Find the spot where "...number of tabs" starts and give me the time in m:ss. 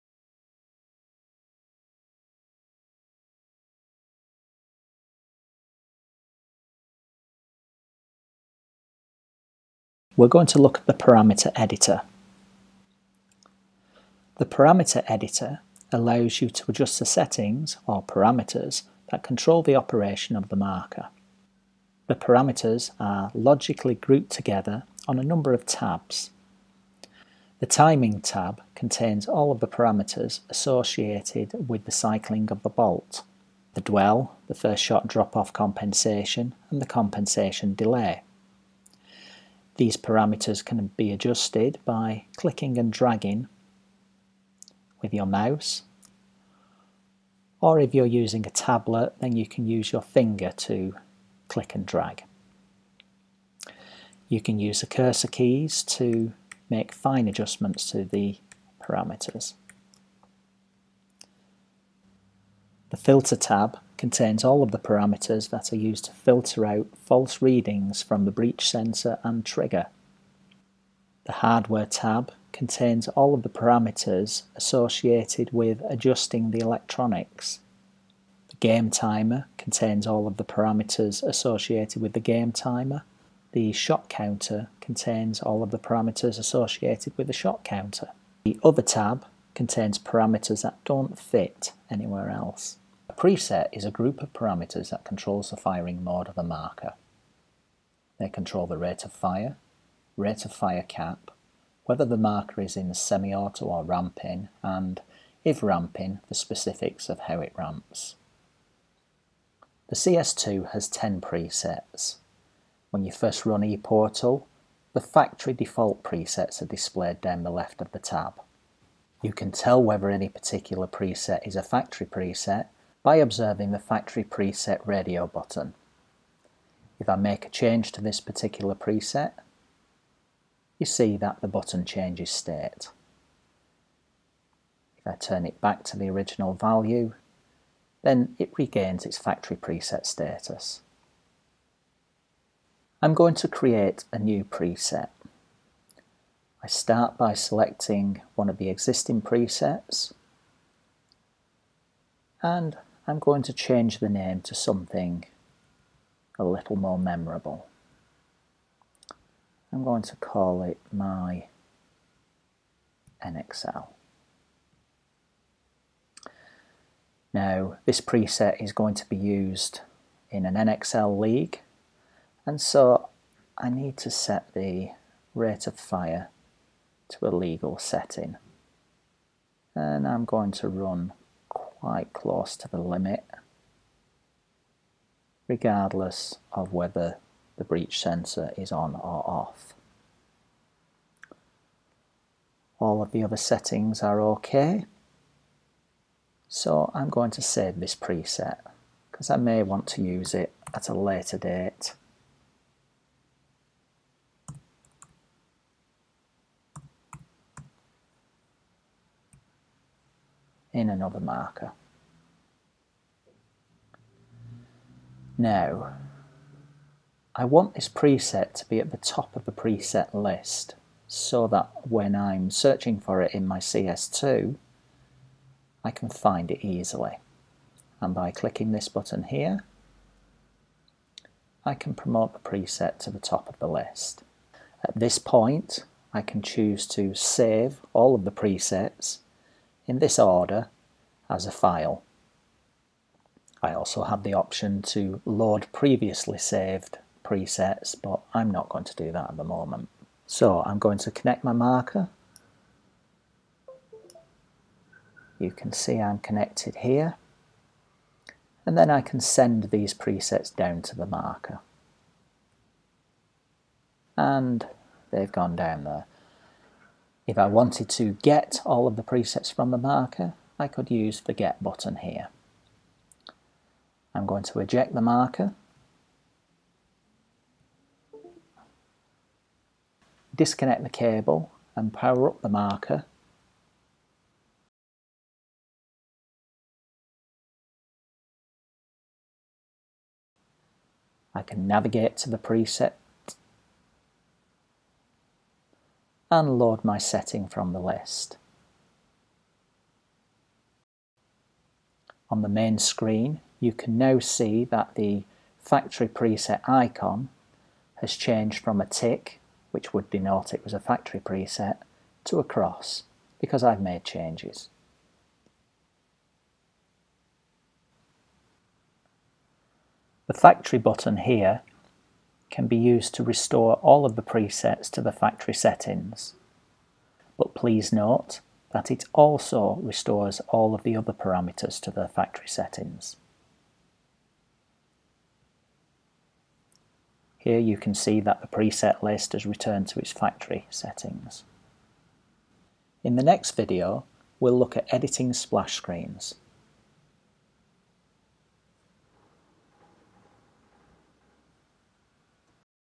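0:25.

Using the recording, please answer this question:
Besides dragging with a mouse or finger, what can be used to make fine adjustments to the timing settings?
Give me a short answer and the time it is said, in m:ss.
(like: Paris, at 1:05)
Cursor keys, at 0:54.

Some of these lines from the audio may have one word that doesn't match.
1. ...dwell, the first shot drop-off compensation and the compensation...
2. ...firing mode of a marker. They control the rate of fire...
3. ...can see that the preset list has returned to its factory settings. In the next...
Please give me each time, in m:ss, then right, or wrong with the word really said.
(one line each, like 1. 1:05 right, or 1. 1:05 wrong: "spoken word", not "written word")
1. 0:33 right
2. 1:35 right
3. 5:37 right.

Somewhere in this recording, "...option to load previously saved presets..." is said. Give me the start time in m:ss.
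4:04.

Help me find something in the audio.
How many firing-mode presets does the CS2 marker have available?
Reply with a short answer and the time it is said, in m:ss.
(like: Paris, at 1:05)
10, at 1:50.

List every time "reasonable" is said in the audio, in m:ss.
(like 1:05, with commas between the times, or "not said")
not said.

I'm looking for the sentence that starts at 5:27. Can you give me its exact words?
But please note that it also restores all of the other parameters to their factory settings.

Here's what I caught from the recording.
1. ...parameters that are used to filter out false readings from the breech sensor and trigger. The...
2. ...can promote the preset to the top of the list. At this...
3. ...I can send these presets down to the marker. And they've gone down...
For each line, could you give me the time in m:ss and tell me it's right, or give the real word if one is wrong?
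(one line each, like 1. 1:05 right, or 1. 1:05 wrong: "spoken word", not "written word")
1. 1:04 right
2. 3:51 right
3. 4:18 right.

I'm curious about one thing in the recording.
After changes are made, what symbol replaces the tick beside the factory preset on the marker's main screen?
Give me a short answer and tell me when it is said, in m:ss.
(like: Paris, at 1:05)
A cross, at 5:12.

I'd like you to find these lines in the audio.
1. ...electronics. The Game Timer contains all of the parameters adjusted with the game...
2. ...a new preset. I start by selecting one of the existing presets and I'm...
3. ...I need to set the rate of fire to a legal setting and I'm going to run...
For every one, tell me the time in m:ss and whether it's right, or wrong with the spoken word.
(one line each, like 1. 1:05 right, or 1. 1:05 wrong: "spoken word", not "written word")
1. 1:16 wrong: "associated", not "adjusted"
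2. 2:24 right
3. 2:53 right.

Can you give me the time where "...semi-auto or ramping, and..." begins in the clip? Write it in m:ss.
1:42.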